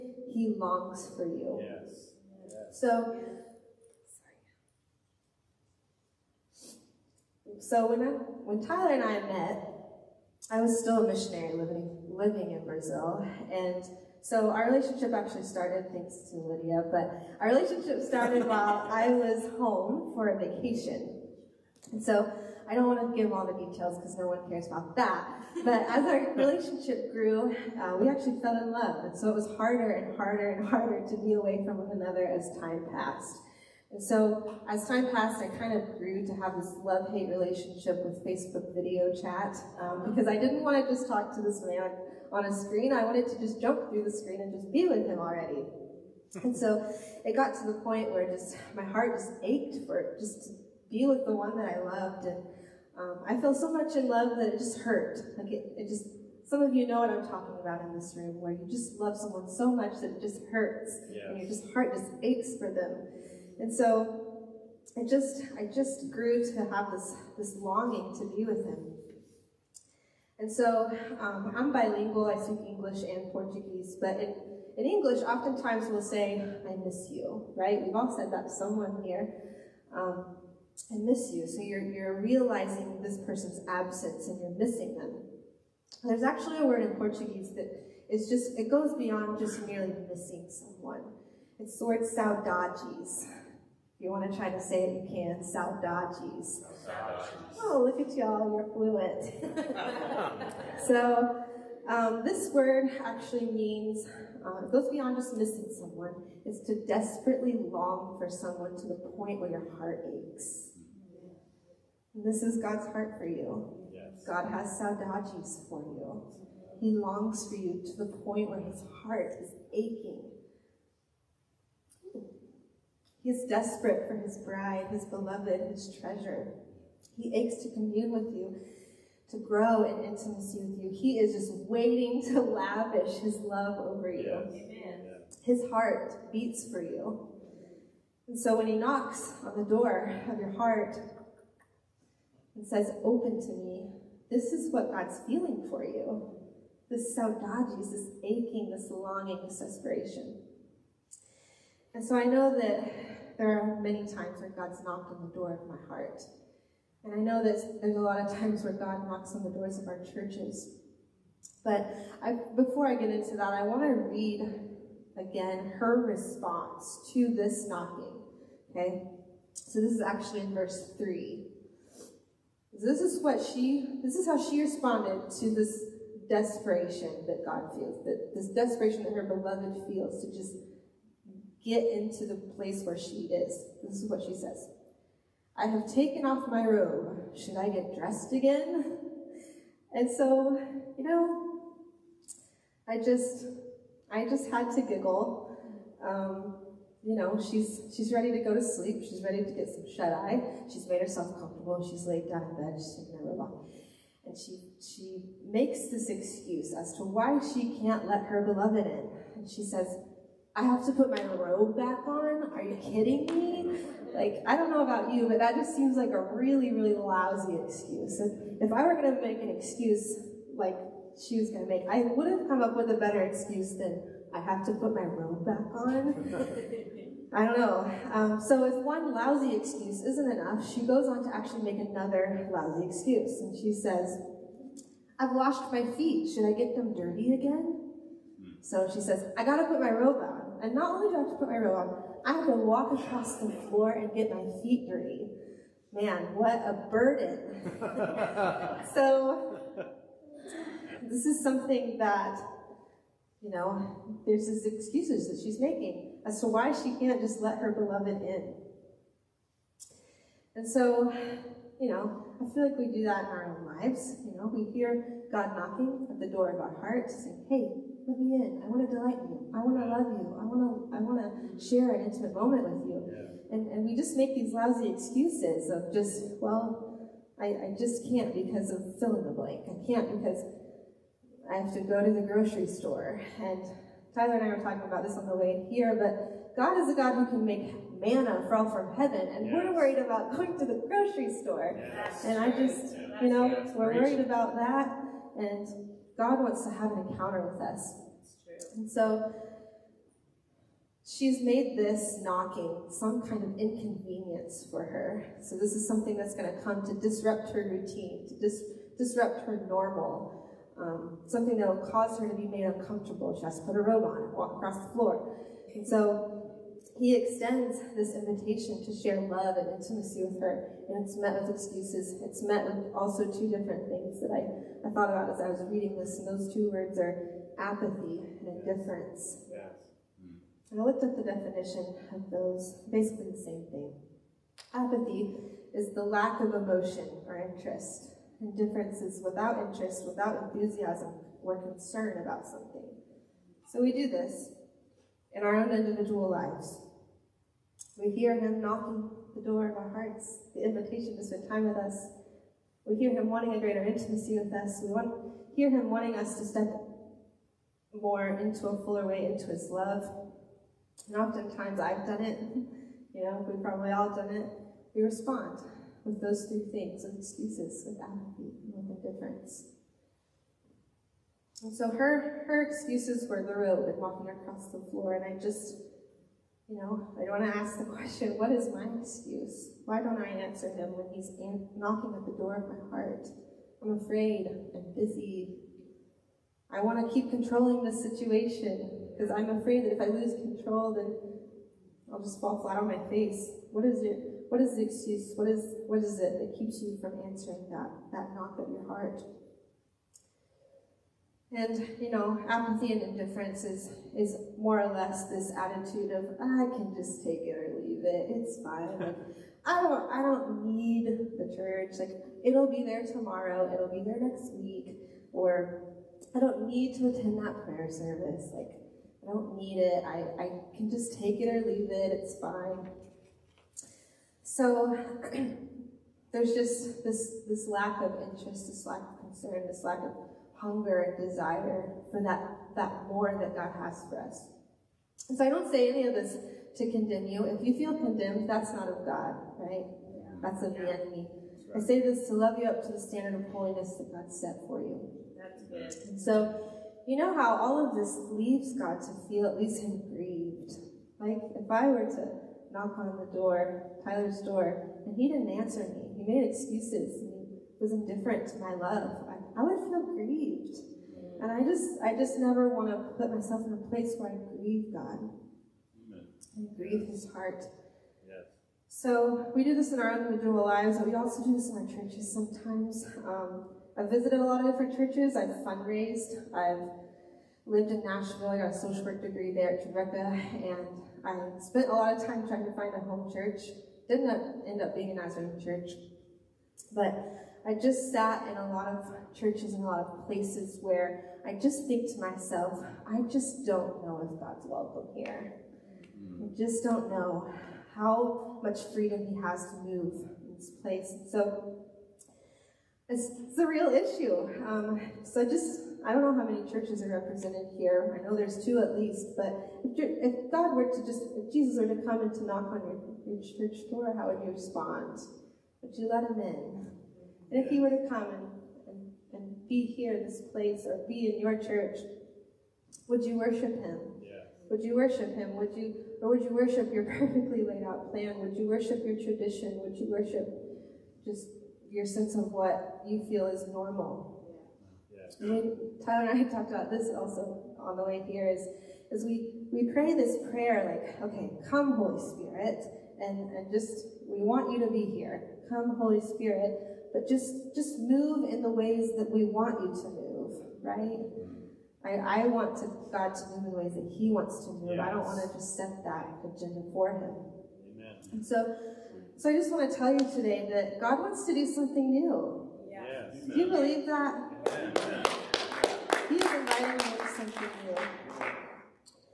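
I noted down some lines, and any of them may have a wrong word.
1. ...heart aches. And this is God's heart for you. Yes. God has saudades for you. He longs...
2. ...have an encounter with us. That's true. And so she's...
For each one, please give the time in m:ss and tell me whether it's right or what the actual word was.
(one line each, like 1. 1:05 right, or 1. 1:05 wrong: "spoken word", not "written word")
1. 1:49 right
2. 4:56 right.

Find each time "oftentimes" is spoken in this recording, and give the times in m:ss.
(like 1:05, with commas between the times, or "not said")
1:15, 6:01.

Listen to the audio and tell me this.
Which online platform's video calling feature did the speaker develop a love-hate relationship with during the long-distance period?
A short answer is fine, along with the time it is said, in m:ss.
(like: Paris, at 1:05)
Facebook, at 0:38.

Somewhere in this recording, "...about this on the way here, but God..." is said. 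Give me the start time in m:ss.
4:44.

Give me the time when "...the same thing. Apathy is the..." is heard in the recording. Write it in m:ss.
5:33.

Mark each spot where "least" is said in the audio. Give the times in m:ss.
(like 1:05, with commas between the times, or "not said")
7:29, 8:28.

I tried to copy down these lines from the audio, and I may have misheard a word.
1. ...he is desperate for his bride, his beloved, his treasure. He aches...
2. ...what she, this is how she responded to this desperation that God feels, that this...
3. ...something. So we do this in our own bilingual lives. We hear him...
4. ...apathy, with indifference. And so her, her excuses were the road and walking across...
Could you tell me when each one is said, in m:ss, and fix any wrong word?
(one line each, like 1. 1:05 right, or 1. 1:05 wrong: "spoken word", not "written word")
1. 2:03 right
2. 2:53 right
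3. 5:42 wrong: "individual", not "bilingual"
4. 6:08 right.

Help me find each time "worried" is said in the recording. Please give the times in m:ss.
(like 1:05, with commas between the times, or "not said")
4:49, 4:53.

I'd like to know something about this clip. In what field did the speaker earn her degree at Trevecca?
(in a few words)
social work.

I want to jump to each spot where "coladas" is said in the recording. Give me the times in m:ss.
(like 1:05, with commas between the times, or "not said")
not said.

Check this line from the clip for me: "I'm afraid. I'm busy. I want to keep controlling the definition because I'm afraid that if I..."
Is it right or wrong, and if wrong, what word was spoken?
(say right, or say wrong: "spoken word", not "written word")
wrong: "situation", not "definition".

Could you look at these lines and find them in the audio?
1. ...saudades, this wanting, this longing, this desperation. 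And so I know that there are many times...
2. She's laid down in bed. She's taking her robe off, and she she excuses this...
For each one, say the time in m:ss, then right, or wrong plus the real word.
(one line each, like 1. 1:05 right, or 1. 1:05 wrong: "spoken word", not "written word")
1. 2:27 wrong: "aching", not "wanting"
2. 3:21 wrong: "makes", not "excuses".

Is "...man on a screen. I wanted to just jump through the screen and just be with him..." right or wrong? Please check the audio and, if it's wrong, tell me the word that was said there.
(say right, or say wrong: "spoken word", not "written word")
right.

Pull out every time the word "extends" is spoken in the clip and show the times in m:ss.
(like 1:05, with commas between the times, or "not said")
5:17.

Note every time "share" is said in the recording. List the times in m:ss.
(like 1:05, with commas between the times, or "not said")
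4:31, 5:18.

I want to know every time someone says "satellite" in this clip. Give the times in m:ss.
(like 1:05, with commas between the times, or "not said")
not said.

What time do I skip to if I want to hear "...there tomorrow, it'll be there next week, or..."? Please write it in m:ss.
6:52.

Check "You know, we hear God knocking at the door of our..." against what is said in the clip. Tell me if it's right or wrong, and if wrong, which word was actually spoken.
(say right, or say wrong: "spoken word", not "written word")
right.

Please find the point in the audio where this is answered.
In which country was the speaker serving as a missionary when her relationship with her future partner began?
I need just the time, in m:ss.
0:12.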